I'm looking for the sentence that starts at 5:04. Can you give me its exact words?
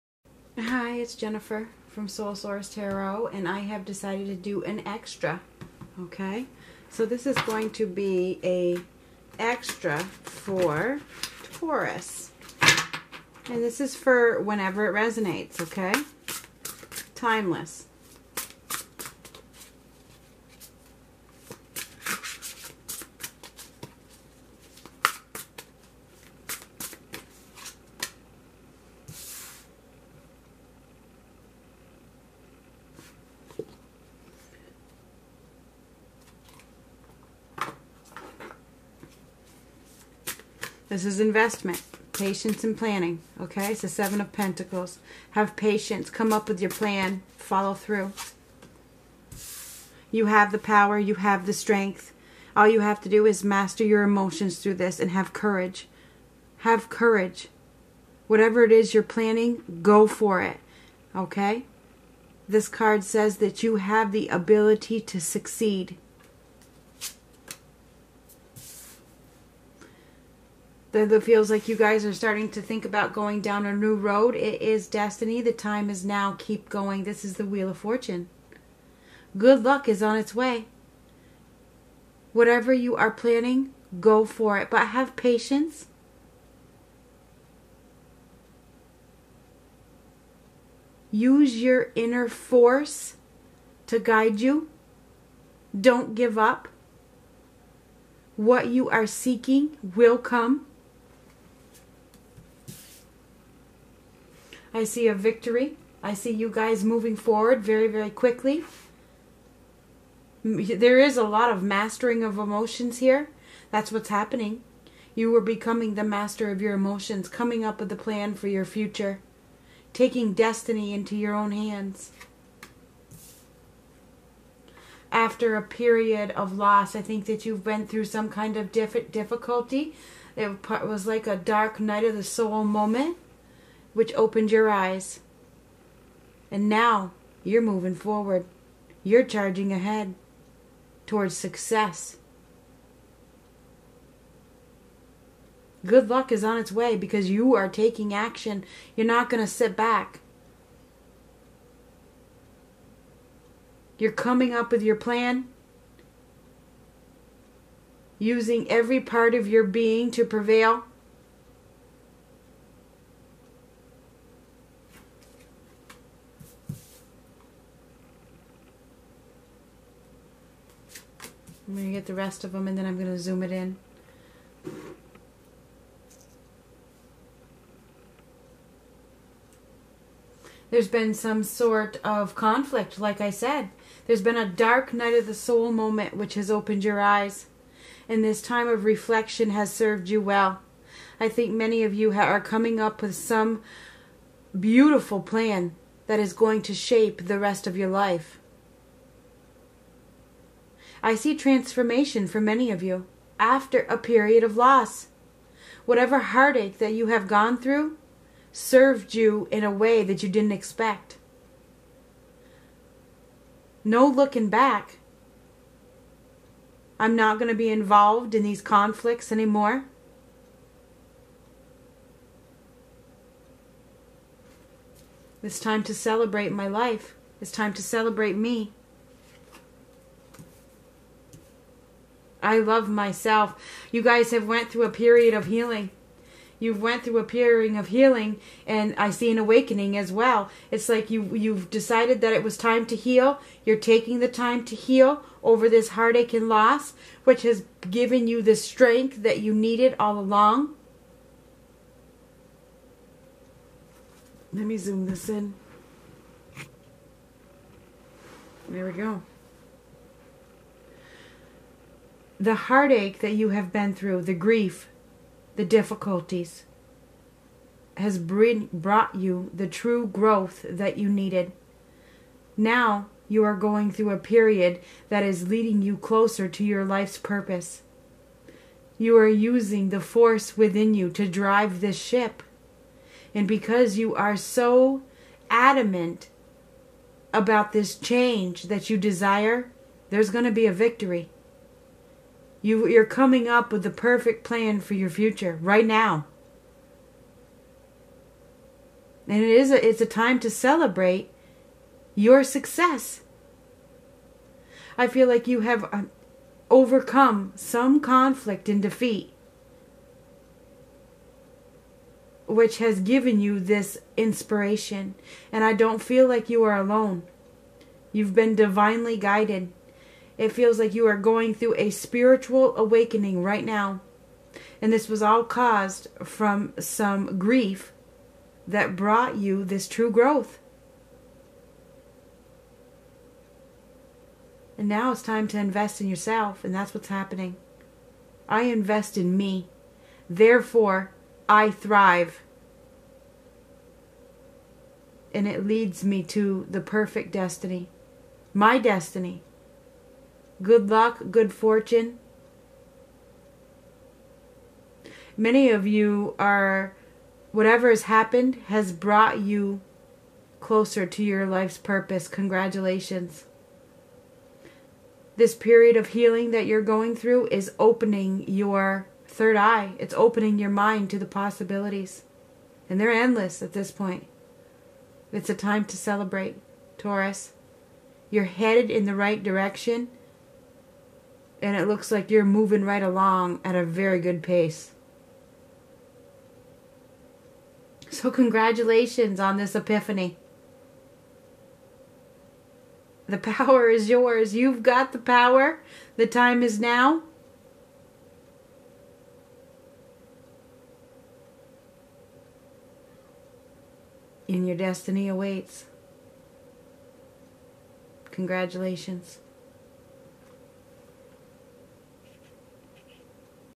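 I feel like you have uh, overcome some conflict and defeat, which has given you this inspiration.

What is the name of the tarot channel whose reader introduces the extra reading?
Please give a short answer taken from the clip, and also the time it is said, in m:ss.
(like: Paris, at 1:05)
Soul Source Tarot, at 0:02.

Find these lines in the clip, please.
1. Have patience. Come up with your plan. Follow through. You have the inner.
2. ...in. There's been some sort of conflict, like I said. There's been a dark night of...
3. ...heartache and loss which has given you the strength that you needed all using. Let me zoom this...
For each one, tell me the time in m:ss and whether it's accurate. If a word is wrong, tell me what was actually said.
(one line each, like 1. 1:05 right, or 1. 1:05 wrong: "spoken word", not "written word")
1. 0:45 wrong: "power", not "inner"
2. 2:53 right
3. 4:05 wrong: "along", not "using".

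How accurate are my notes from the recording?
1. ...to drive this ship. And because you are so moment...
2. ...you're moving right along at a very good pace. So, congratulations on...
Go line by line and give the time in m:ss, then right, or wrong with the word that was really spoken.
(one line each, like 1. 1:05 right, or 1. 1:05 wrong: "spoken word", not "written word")
1. 4:41 wrong: "adamant", not "moment"
2. 6:22 right.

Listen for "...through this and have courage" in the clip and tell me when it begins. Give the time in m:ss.
0:54.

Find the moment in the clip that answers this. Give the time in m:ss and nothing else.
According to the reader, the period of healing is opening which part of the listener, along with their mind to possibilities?
6:09.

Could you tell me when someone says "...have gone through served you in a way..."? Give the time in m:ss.
3:27.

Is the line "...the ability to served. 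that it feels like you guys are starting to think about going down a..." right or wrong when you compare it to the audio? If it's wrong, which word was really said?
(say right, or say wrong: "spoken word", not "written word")
wrong: "succeed", not "served".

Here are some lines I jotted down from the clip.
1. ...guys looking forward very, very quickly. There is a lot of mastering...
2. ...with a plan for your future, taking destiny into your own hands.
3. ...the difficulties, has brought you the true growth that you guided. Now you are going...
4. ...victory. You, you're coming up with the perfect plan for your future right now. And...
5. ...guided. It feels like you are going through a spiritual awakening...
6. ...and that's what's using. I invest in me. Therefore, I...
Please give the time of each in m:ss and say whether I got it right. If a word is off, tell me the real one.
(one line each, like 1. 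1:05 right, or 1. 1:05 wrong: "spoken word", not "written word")
1. 1:46 wrong: "moving", not "looking"
2. 1:57 right
3. 4:25 wrong: "needed", not "guided"
4. 4:50 right
5. 5:19 right
6. 5:36 wrong: "happening", not "using".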